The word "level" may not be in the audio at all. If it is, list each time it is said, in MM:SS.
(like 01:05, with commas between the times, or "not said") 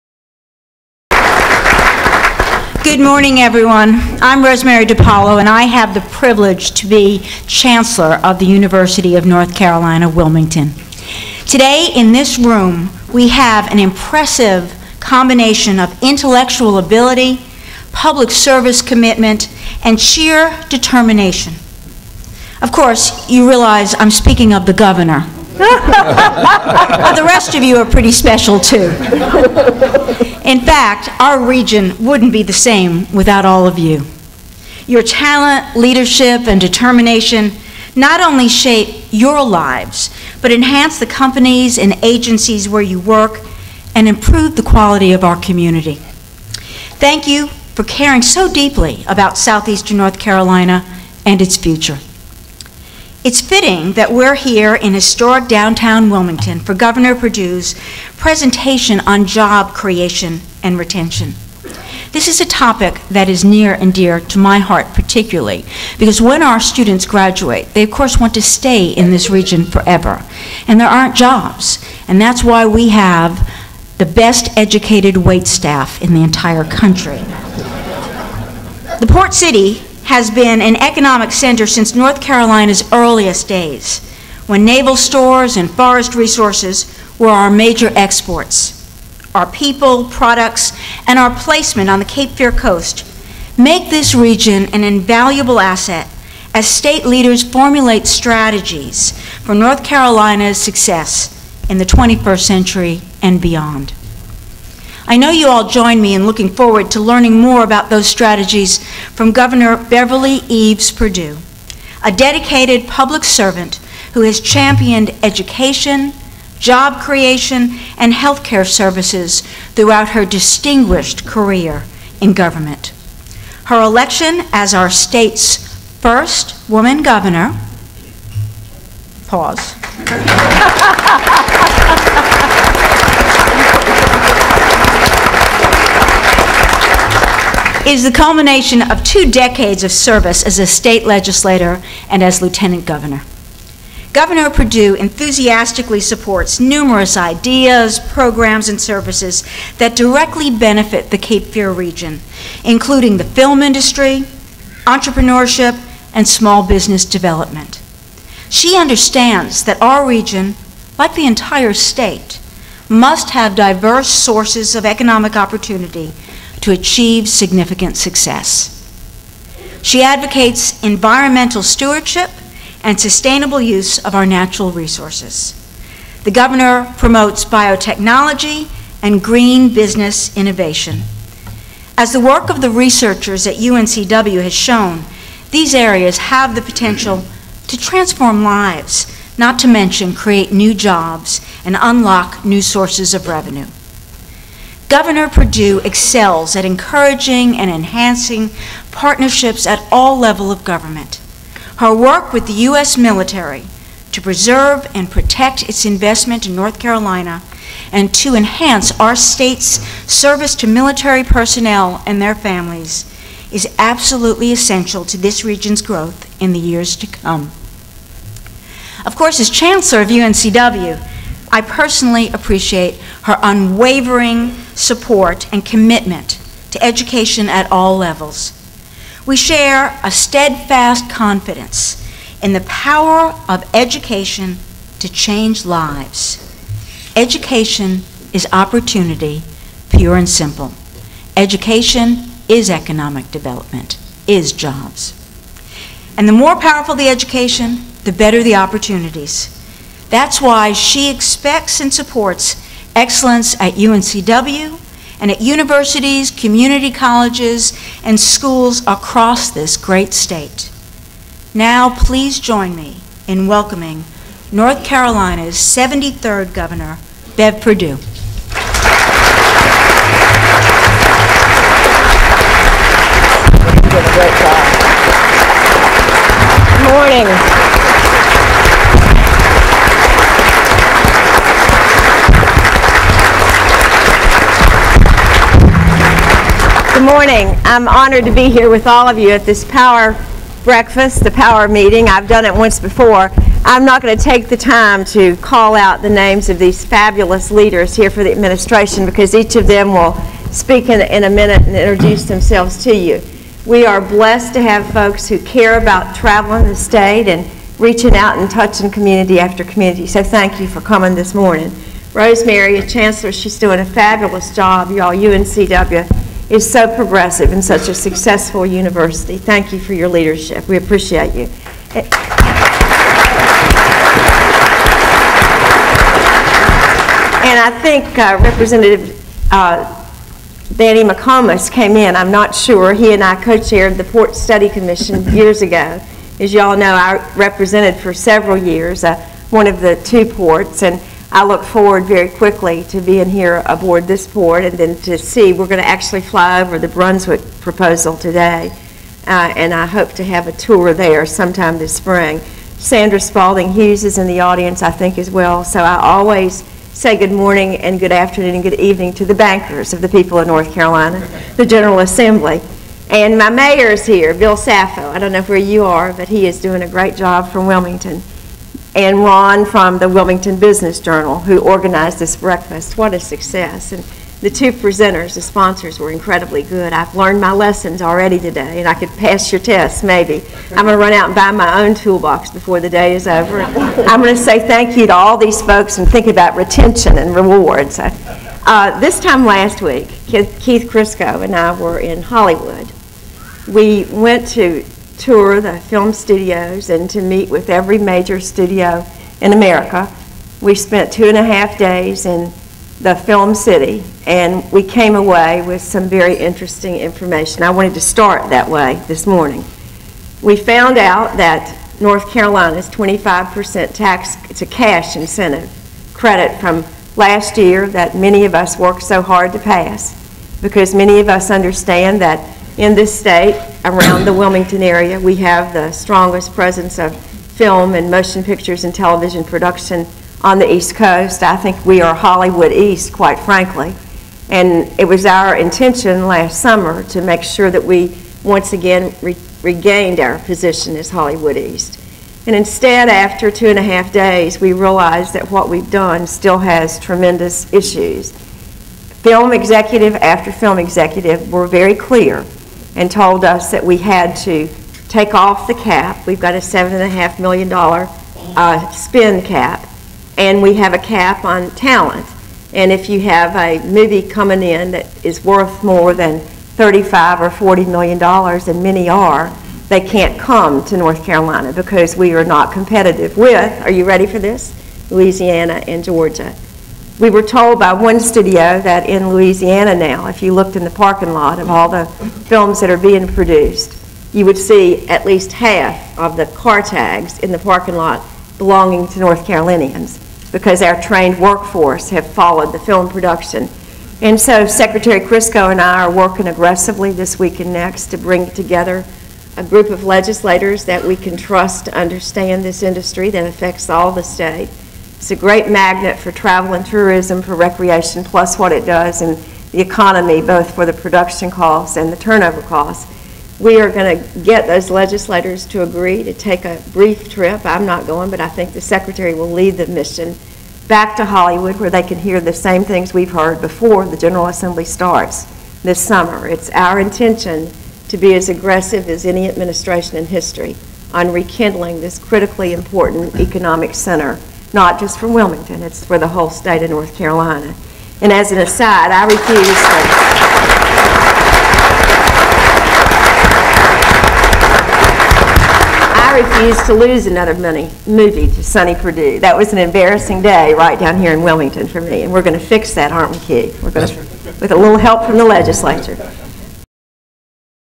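03:20, 03:47.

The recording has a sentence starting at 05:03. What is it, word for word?
We are blessed to have folks who care about traveling the state and reaching out and touching community after community.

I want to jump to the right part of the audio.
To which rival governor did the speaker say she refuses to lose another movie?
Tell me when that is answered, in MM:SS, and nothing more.
09:08.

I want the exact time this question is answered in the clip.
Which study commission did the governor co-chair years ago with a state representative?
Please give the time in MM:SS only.
05:34.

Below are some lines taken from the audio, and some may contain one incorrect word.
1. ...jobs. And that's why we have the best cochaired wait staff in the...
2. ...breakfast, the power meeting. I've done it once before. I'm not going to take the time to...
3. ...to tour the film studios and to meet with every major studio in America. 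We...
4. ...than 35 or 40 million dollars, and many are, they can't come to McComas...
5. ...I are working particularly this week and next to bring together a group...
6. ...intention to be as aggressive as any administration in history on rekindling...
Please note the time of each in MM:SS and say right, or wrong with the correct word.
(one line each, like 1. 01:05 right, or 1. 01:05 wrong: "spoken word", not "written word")
1. 01:11 wrong: "educated", not "cochaired"
2. 04:50 right
3. 06:34 right
4. 07:46 wrong: "North", not "McComas"
5. 08:15 wrong: "aggressively", not "particularly"
6. 08:46 right.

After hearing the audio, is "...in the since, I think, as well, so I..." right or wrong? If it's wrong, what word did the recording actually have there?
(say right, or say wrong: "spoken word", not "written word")
wrong: "audience", not "since".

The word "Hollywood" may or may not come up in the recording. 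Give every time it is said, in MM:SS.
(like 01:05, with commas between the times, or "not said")
06:32, 07:12, 07:21, 08:41.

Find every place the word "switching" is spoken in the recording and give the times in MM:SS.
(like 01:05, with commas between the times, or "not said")
not said.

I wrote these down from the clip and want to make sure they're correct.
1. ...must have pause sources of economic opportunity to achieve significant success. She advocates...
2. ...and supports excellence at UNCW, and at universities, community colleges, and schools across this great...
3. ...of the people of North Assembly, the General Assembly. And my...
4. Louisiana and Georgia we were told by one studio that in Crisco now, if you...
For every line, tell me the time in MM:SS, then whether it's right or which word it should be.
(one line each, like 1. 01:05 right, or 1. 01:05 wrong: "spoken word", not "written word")
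1. 02:42 wrong: "diverse", not "pause"
2. 04:11 right
3. 05:59 wrong: "Carolina", not "Assembly"
4. 07:55 wrong: "Louisiana", not "Crisco".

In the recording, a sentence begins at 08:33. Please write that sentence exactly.
We are going to get those legislators to agree to take a brief trip.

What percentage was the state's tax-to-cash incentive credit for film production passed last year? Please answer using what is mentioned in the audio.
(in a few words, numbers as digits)
25%.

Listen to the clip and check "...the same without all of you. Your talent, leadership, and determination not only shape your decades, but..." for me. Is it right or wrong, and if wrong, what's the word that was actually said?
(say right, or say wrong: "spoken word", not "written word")
wrong: "lives", not "decades".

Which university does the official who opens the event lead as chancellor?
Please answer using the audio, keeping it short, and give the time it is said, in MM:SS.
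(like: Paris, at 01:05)
University of North Carolina, Wilmington, at 00:08.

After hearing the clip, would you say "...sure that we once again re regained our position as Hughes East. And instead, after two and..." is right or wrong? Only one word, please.
wrong.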